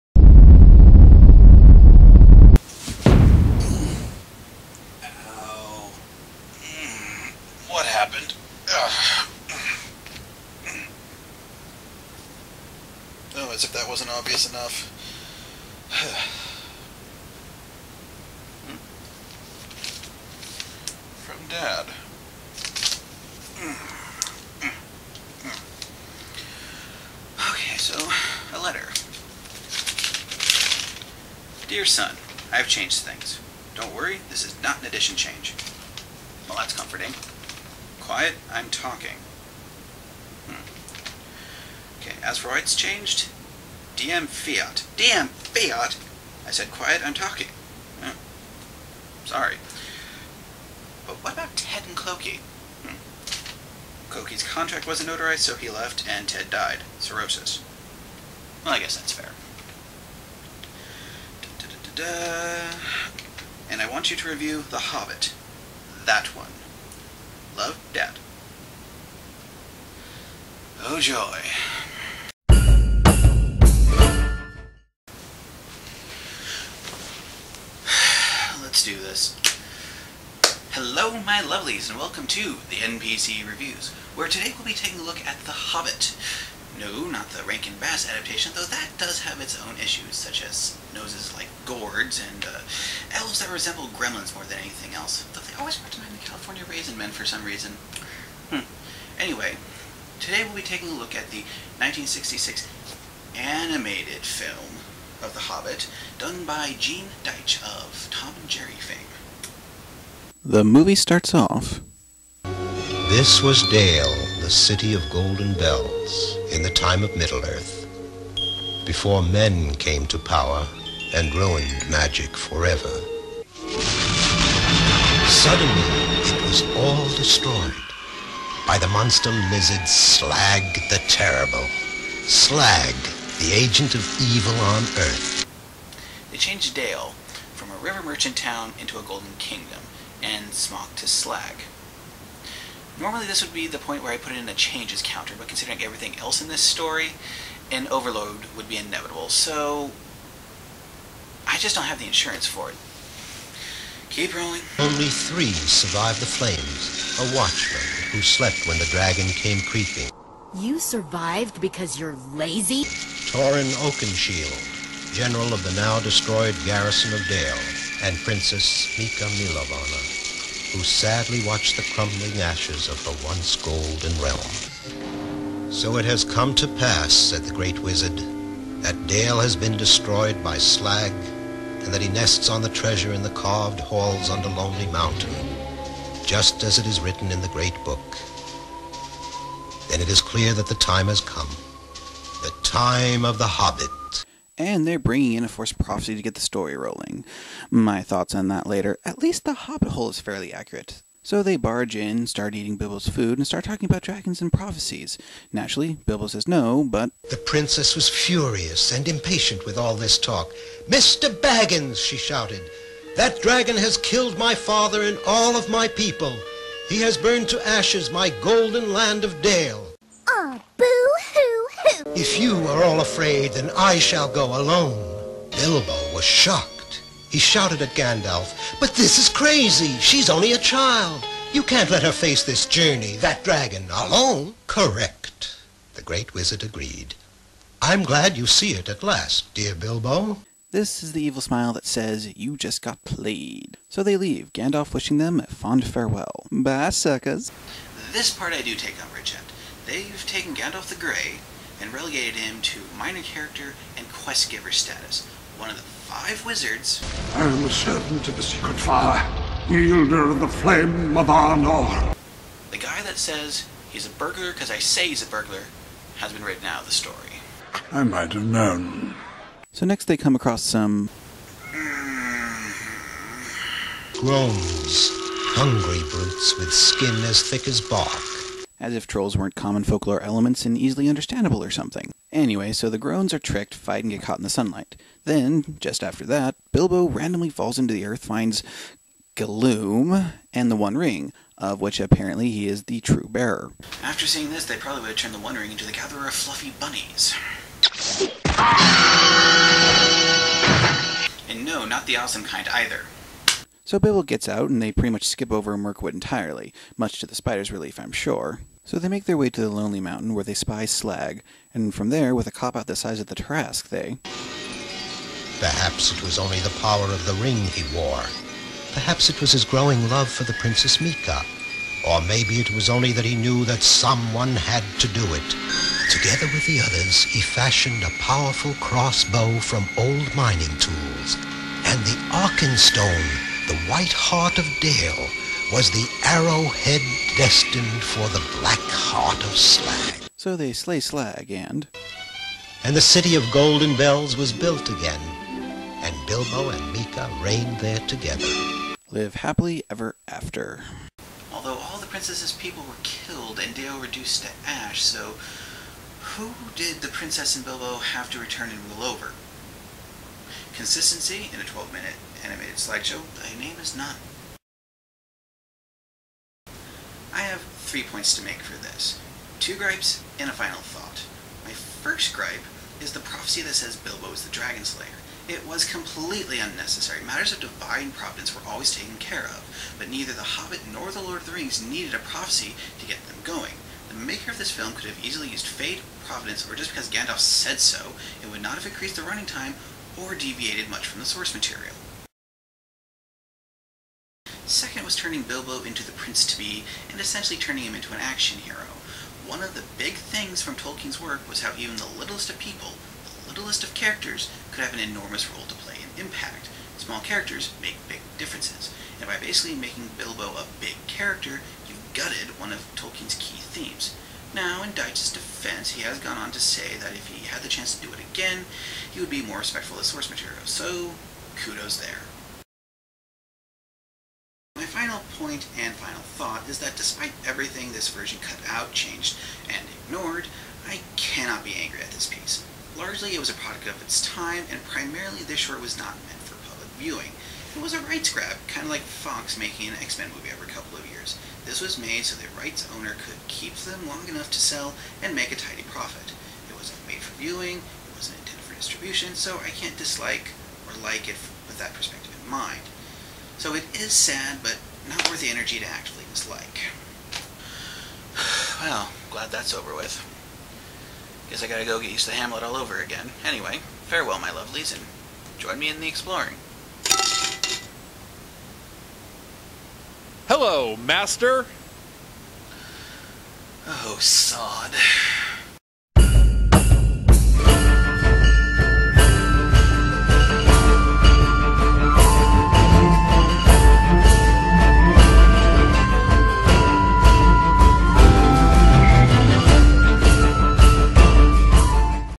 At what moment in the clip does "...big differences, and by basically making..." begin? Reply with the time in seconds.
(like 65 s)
408 s.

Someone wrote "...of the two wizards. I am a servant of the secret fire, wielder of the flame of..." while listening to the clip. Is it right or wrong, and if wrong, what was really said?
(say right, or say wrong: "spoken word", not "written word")
wrong: "five", not "two".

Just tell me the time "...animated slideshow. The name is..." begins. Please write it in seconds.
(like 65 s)
362 s.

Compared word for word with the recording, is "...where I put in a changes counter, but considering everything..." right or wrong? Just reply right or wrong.
right.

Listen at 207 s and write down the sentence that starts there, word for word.
The princess was furious and impatient with all this talk.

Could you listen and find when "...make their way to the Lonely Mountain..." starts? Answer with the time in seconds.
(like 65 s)
309 s.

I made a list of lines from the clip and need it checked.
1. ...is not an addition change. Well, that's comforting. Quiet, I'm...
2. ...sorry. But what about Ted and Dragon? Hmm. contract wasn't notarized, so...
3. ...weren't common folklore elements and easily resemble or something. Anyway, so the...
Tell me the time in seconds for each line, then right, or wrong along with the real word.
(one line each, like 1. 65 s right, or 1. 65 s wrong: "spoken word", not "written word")
1. 34 s right
2. 49 s wrong: "Clokey", not "Dragon"
3. 279 s wrong: "understandable", not "resemble".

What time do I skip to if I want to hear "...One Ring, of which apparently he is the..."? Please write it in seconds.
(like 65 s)
290 s.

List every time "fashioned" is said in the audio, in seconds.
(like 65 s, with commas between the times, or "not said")
327 s.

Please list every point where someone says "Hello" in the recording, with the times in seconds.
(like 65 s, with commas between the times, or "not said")
80 s, 470 s.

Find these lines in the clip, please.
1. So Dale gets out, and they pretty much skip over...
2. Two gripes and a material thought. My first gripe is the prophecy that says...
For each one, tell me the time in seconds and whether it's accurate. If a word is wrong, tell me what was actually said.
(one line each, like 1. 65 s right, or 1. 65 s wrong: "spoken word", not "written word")
1. 303 s wrong: "Bilbo", not "Dale"
2. 369 s wrong: "final", not "material".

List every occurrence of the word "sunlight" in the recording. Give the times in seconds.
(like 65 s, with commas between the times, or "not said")
284 s.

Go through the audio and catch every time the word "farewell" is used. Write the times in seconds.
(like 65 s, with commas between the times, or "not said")
245 s, 464 s.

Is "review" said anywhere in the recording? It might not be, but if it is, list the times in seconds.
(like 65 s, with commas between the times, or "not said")
64 s, 83 s.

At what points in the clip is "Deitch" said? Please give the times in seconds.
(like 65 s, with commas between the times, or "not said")
107 s, 414 s.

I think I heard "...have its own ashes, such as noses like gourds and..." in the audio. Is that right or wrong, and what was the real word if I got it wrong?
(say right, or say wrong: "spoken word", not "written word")
wrong: "issues", not "ashes".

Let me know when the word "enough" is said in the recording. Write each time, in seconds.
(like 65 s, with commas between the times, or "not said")
14 s, 444 s.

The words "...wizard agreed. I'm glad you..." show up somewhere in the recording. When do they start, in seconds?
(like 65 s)
236 s.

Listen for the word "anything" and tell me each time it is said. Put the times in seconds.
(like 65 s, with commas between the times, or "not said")
94 s.